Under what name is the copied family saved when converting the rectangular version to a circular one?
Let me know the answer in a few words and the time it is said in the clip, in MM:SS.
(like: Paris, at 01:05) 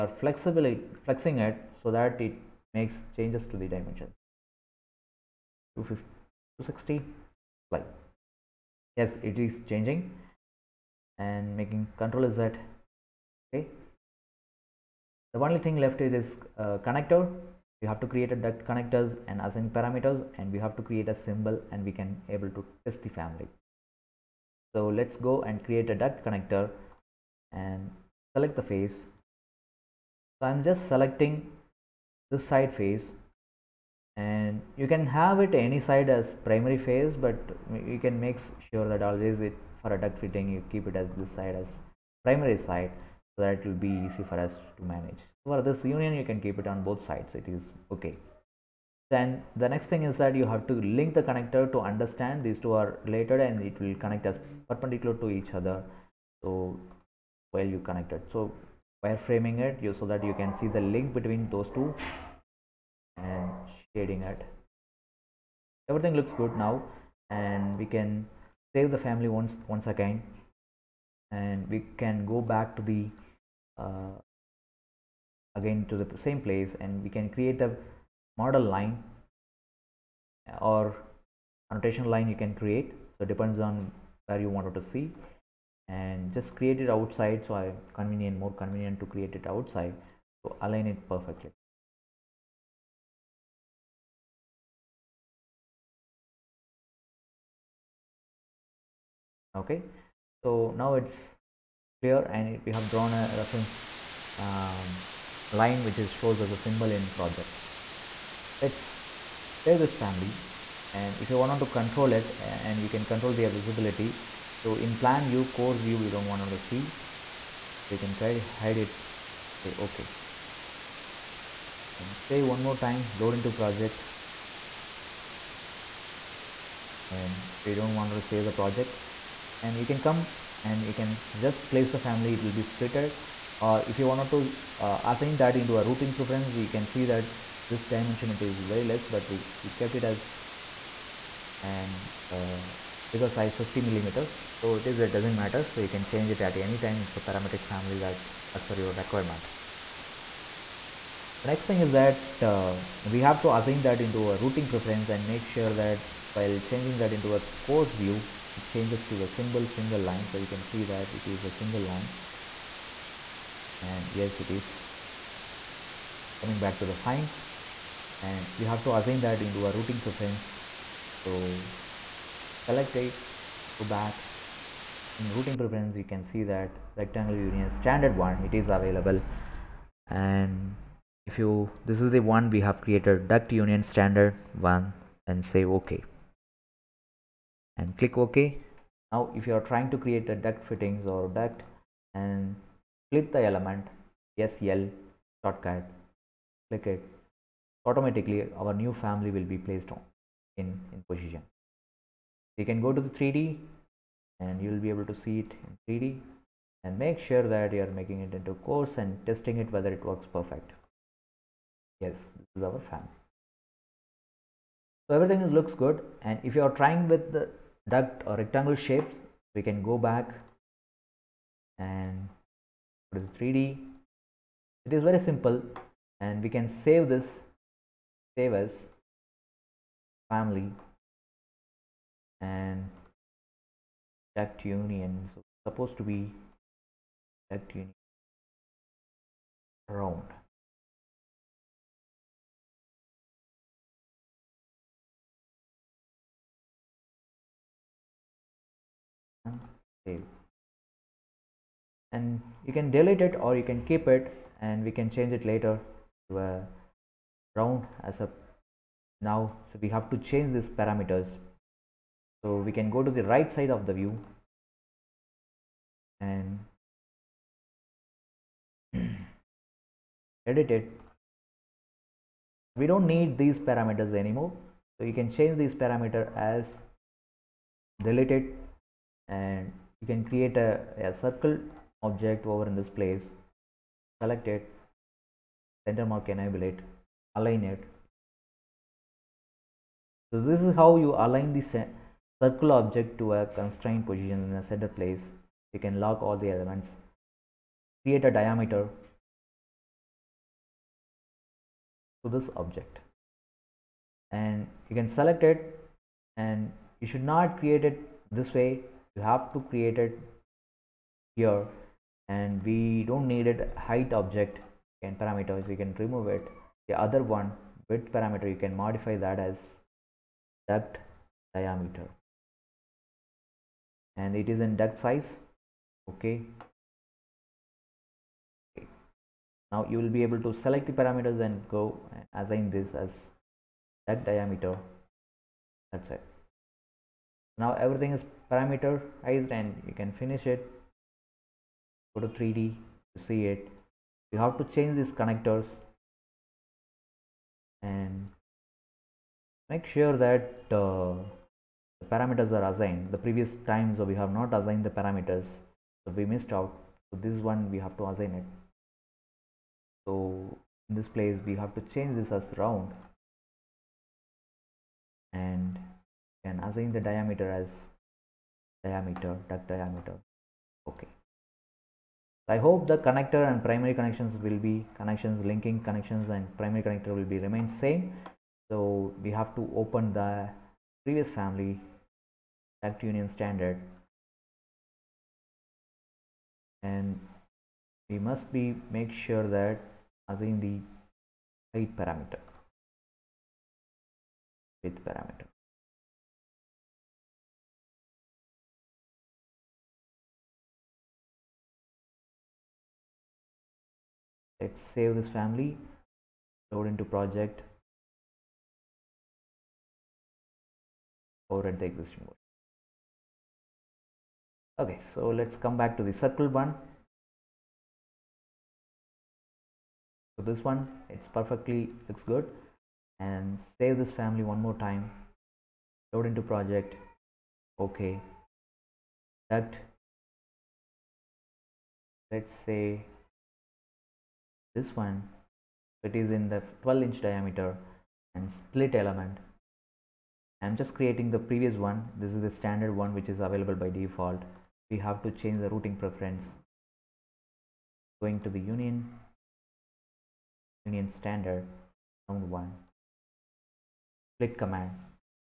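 duct union round, at 03:57.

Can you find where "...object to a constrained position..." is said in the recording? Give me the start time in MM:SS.
04:52.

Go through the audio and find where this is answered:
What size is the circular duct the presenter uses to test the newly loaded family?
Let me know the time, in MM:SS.
07:16.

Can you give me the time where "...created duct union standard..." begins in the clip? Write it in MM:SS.
03:02.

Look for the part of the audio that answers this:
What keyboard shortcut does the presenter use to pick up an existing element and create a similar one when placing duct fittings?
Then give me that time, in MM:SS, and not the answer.
03:14.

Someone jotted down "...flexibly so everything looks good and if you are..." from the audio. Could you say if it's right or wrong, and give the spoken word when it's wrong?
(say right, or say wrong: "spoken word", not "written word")
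wrong: "family", not "flexibly".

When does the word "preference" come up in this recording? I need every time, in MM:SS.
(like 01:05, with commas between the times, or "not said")
02:16, 02:34, 02:50, 02:55, 07:26.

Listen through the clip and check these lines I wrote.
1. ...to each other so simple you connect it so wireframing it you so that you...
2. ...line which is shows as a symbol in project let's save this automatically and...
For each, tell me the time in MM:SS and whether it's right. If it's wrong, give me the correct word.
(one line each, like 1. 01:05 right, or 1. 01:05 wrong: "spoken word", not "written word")
1. 00:55 wrong: "while", not "simple"
2. 01:45 wrong: "family", not "automatically".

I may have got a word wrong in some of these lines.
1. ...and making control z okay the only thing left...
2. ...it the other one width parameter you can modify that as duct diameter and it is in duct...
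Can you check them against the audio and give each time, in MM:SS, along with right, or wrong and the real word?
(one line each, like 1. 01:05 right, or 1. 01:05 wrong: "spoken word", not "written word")
1. 00:11 right
2. 05:16 right.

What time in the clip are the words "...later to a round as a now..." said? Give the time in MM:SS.
04:15.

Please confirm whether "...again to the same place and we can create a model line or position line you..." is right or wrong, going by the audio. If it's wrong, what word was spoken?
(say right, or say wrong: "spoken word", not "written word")
wrong: "annotation", not "position".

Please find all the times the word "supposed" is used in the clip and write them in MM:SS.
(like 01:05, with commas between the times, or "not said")
03:55.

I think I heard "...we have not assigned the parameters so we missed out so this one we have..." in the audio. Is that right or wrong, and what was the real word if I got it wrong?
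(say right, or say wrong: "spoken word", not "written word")
right.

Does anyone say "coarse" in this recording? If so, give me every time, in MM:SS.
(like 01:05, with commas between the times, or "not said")
01:55, 02:37, 03:28.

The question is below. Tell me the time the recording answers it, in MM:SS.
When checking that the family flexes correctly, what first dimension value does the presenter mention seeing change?
00:05.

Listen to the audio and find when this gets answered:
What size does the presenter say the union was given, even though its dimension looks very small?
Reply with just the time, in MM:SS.
02:23.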